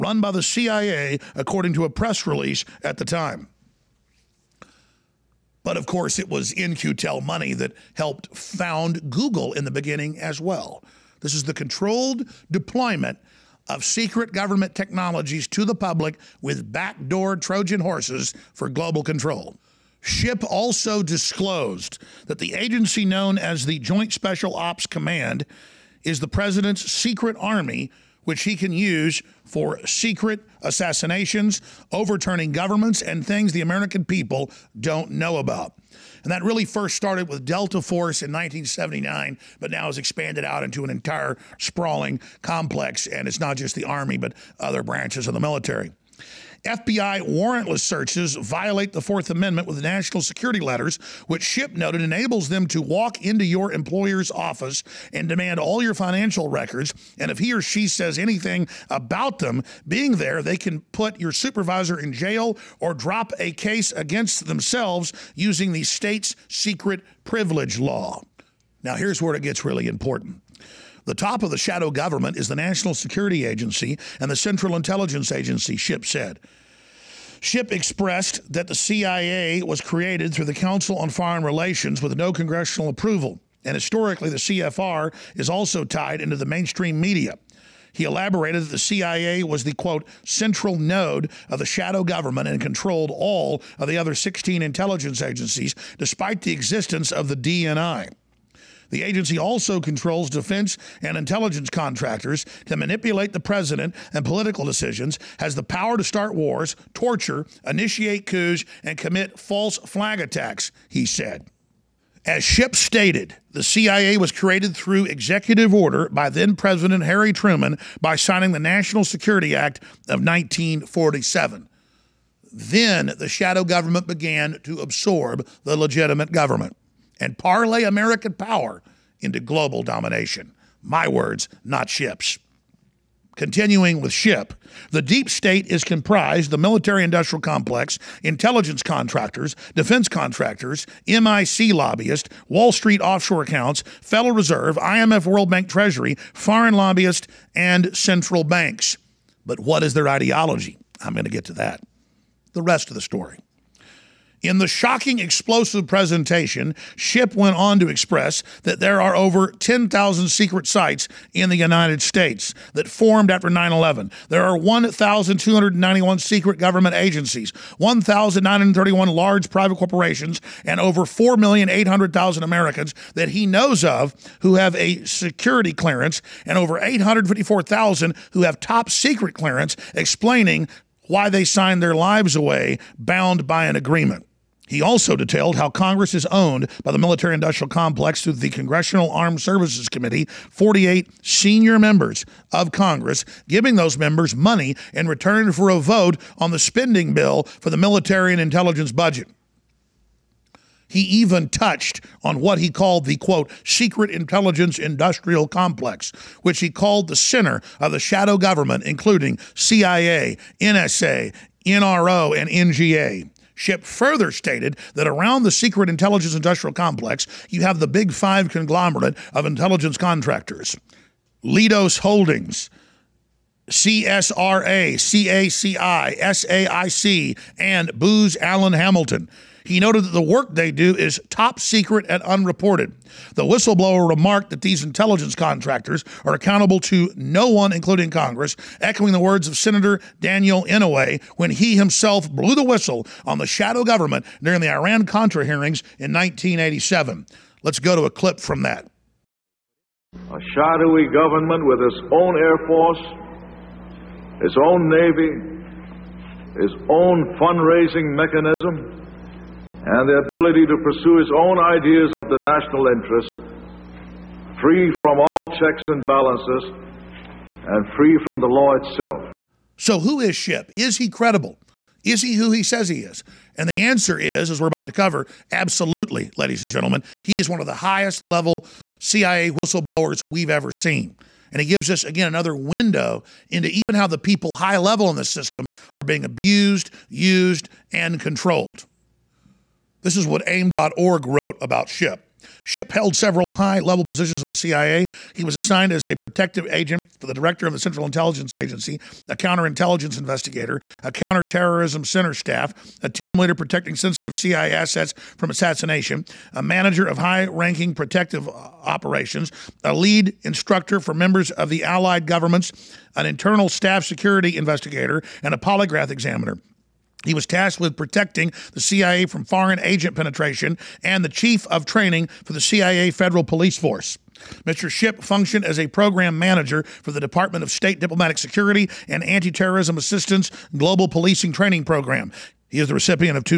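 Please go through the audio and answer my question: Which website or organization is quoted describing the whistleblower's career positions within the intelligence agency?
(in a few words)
AIM.org.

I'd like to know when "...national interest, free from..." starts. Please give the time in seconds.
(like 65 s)
262 s.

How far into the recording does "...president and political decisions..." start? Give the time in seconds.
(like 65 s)
103 s.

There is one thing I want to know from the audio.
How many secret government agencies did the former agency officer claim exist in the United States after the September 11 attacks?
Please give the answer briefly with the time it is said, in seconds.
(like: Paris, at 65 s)
1,291, at 164 s.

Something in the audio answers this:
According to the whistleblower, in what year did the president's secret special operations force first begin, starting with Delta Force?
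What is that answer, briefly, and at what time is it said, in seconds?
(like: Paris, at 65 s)
1979, at 38 s.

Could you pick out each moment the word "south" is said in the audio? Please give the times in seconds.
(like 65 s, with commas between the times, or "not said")
not said.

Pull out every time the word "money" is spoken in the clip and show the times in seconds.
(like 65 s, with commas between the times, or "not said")
7 s, 194 s.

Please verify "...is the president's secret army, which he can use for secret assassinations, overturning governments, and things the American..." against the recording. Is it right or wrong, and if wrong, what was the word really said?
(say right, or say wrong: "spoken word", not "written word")
right.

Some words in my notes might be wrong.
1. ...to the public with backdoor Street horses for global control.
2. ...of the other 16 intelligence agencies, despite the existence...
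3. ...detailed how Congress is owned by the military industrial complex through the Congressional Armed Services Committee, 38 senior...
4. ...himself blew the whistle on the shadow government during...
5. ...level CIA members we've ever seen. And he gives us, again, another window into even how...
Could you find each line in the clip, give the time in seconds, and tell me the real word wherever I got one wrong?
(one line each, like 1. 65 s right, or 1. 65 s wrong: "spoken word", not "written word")
1. 15 s wrong: "Trojan", not "Street"
2. 93 s right
3. 185 s wrong: "48", not "38"
4. 241 s right
5. 278 s wrong: "whistleblowers", not "members".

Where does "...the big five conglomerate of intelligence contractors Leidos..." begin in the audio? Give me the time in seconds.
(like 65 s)
217 s.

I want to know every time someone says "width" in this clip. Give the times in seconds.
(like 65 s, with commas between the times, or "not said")
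not said.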